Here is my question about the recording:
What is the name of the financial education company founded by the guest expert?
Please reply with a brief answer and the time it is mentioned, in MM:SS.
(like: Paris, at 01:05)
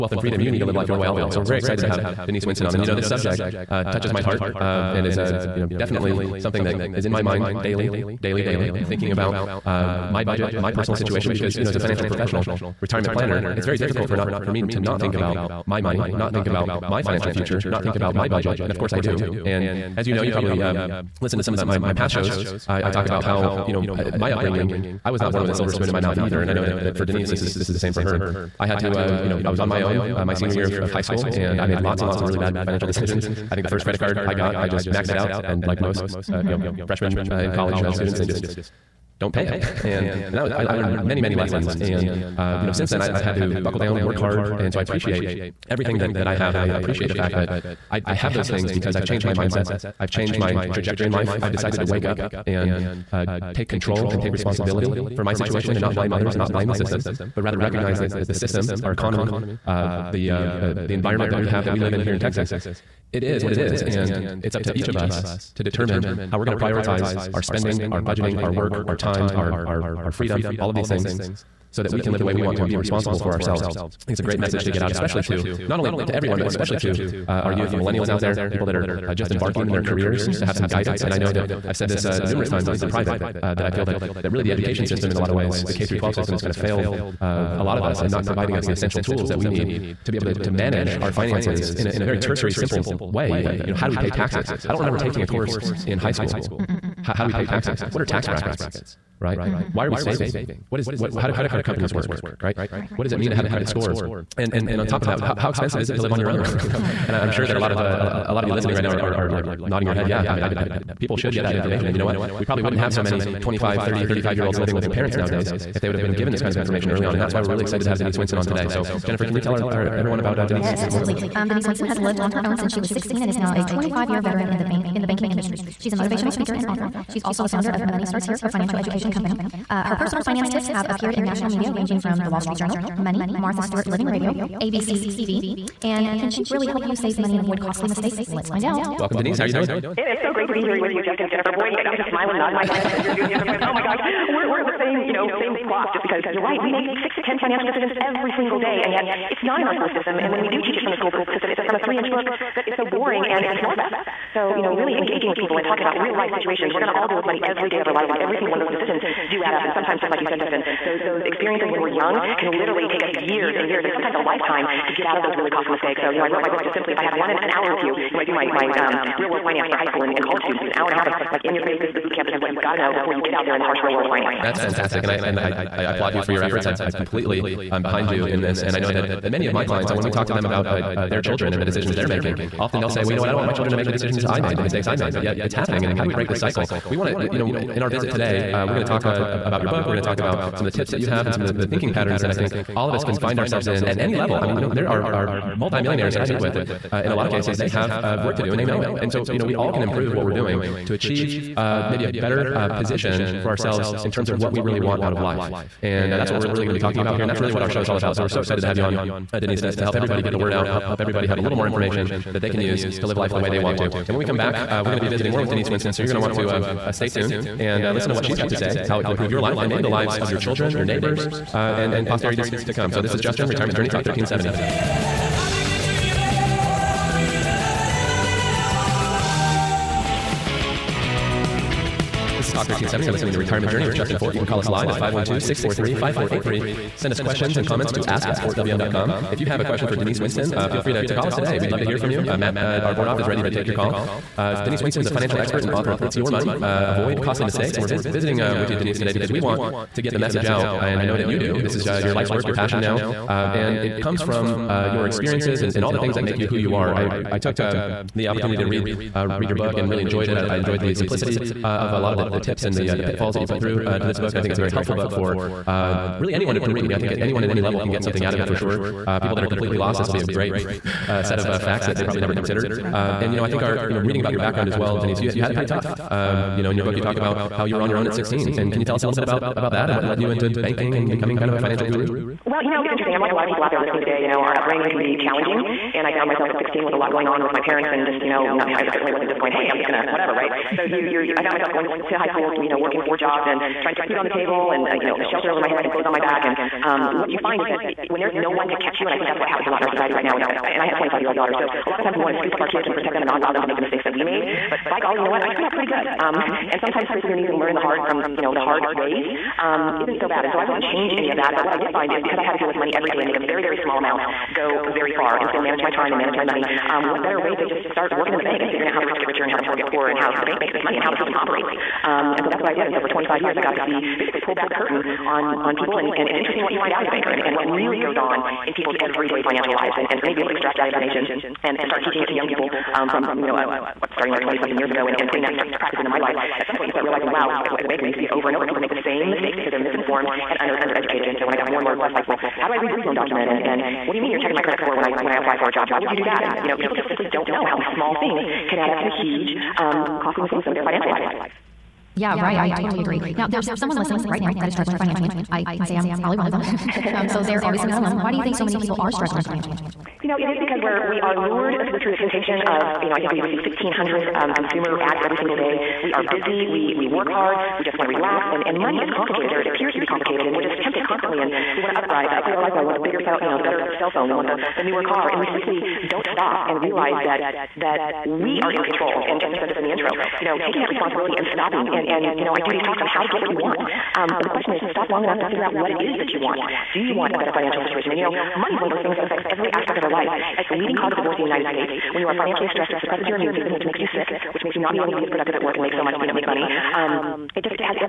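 Money Starts Here, at 02:07.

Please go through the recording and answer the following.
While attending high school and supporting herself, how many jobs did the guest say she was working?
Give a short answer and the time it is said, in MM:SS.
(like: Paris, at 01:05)
4, at 04:53.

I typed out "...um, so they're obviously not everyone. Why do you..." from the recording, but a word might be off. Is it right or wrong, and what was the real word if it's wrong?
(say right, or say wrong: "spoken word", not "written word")
wrong: "alone", not "everyone".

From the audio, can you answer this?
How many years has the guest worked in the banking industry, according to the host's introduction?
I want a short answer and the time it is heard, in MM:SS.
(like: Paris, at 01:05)
25, at 02:03.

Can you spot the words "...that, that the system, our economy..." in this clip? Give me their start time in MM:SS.
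00:57.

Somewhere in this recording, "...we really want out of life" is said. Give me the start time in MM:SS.
03:24.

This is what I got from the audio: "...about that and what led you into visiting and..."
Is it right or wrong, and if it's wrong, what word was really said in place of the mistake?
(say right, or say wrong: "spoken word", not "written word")
wrong: "banking", not "visiting".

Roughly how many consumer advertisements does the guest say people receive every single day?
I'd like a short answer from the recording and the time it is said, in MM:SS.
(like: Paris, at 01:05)
1500, at 06:03.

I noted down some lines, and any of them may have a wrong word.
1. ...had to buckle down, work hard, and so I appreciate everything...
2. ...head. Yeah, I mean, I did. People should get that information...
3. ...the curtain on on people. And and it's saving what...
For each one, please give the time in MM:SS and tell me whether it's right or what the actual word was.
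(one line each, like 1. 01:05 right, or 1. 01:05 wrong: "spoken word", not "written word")
1. 00:43 right
2. 01:49 right
3. 05:24 wrong: "interesting", not "saving".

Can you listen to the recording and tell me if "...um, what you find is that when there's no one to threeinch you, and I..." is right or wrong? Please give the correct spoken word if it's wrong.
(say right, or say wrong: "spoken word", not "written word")
wrong: "catch", not "threeinch".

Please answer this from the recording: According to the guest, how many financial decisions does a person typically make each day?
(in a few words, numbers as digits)
6 to 10.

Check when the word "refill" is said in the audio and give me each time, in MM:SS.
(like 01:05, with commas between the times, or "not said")
not said.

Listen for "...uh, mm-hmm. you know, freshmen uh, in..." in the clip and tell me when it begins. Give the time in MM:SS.
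00:36.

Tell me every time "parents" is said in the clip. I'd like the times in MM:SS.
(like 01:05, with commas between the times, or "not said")
01:54, 04:47.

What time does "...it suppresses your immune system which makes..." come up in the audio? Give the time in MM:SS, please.
06:32.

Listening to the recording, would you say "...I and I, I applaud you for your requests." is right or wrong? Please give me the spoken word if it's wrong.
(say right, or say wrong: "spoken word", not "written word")
wrong: "efforts", not "requests".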